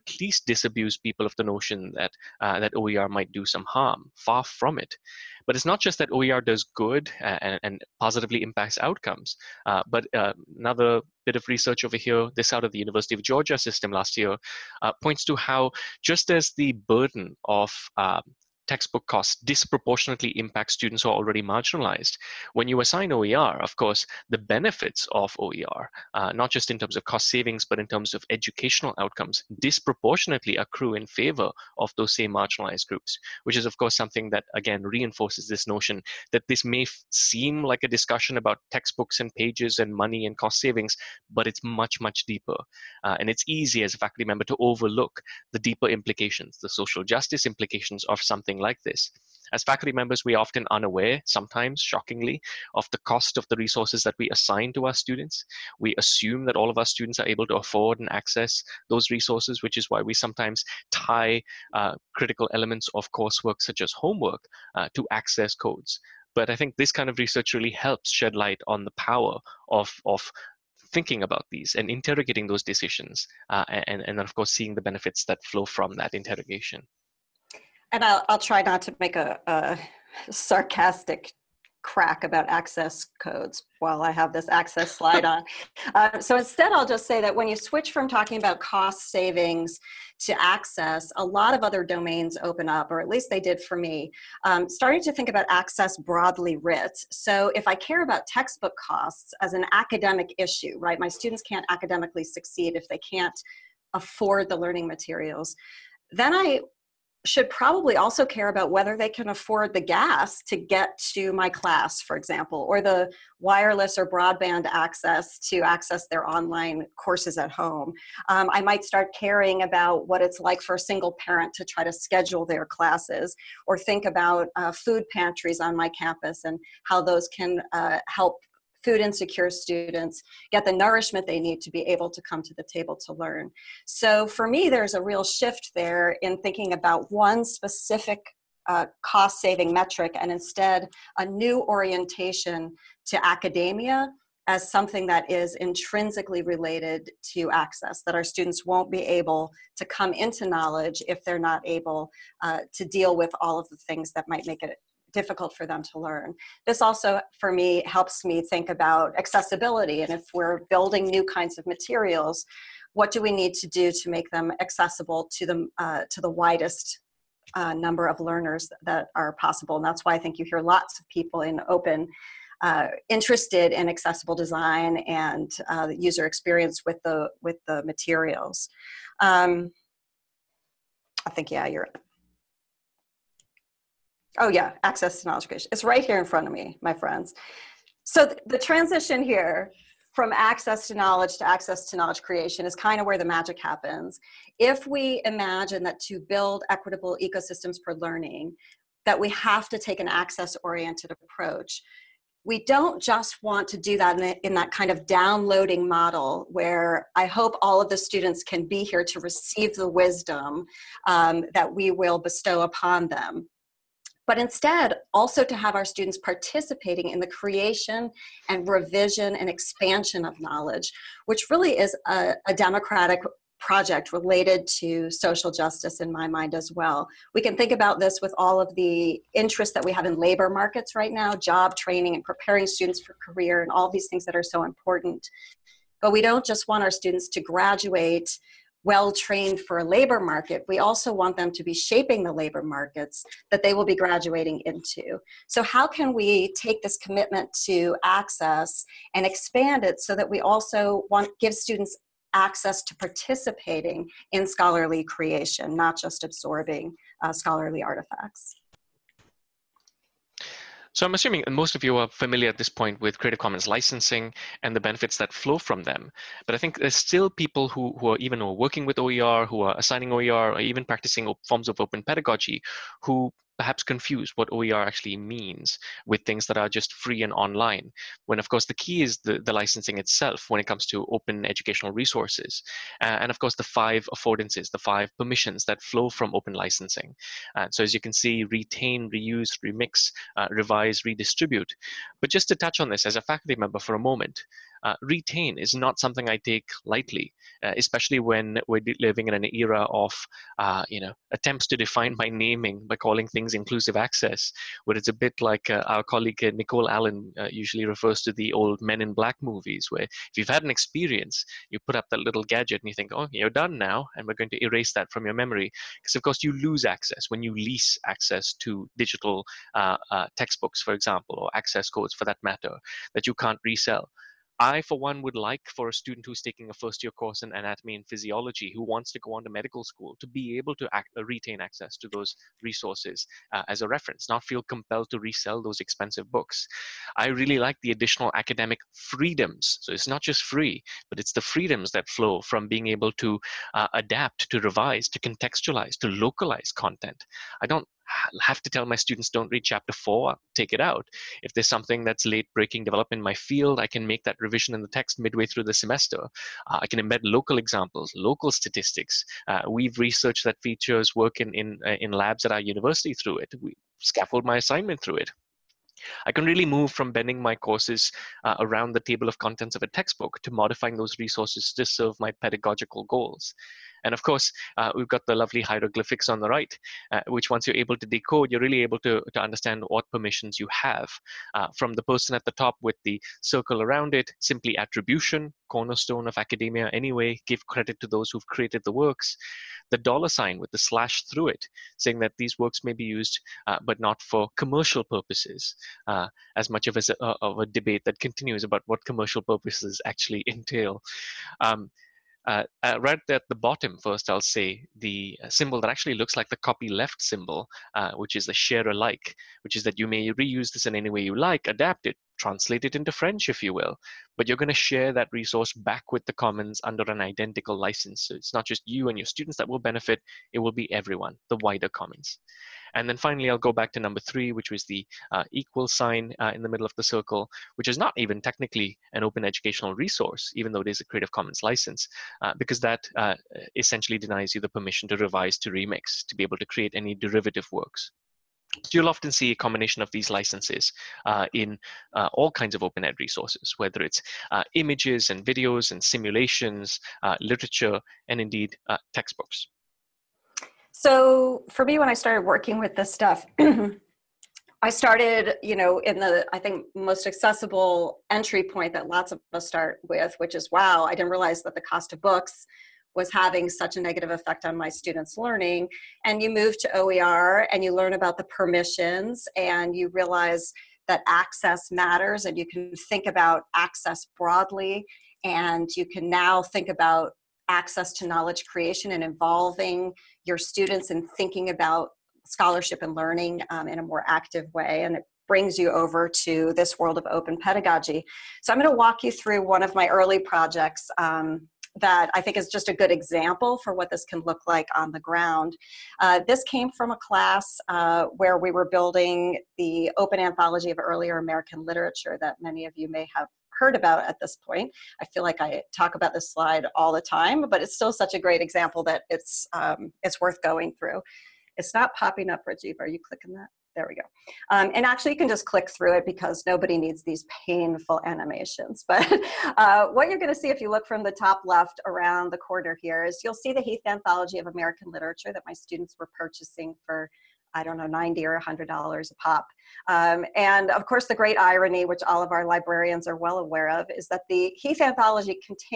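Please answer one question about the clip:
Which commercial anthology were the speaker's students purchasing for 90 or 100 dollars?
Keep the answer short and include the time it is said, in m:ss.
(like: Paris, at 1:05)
Heath Anthology of American Literature, at 8:43.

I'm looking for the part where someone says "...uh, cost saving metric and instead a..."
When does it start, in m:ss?
2:18.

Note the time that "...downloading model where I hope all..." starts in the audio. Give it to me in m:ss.
3:25.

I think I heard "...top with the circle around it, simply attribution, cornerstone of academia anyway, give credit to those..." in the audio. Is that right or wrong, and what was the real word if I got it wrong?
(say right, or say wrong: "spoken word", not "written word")
right.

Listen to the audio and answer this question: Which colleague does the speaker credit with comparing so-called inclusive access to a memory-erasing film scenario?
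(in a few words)
Nicole Allen.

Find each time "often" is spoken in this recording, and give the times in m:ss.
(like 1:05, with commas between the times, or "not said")
0:50, 7:19.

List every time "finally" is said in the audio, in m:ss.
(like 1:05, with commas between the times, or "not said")
7:03.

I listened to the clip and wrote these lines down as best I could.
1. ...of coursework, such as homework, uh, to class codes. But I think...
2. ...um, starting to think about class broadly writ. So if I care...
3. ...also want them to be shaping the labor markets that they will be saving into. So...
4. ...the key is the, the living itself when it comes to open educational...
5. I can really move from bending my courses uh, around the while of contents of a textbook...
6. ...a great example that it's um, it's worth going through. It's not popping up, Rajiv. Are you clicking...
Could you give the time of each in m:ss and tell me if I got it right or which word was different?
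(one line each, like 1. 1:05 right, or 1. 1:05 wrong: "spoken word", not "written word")
1. 1:02 wrong: "access", not "class"
2. 1:34 wrong: "access", not "class"
3. 4:00 wrong: "graduating", not "saving"
4. 4:38 wrong: "licensing", not "living"
5. 6:06 wrong: "table", not "while"
6. 8:28 right.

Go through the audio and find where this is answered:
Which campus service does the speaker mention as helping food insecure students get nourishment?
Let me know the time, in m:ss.
2:04.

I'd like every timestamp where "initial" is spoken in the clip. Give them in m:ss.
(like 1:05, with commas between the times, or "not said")
not said.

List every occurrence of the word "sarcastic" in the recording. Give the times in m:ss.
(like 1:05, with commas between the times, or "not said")
1:20.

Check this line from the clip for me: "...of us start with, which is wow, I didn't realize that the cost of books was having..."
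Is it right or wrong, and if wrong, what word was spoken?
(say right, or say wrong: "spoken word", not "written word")
right.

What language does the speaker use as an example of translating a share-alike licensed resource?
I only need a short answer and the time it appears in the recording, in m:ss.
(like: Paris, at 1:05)
French, at 6:53.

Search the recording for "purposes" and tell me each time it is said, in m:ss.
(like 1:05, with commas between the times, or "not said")
6:35, 6:39.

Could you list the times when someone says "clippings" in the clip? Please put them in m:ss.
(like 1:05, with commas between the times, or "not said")
not said.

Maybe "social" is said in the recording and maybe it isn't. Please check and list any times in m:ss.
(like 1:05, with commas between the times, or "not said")
0:46, 3:45.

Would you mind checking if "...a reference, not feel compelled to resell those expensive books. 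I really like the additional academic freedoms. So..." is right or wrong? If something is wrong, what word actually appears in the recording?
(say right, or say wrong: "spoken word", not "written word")
right.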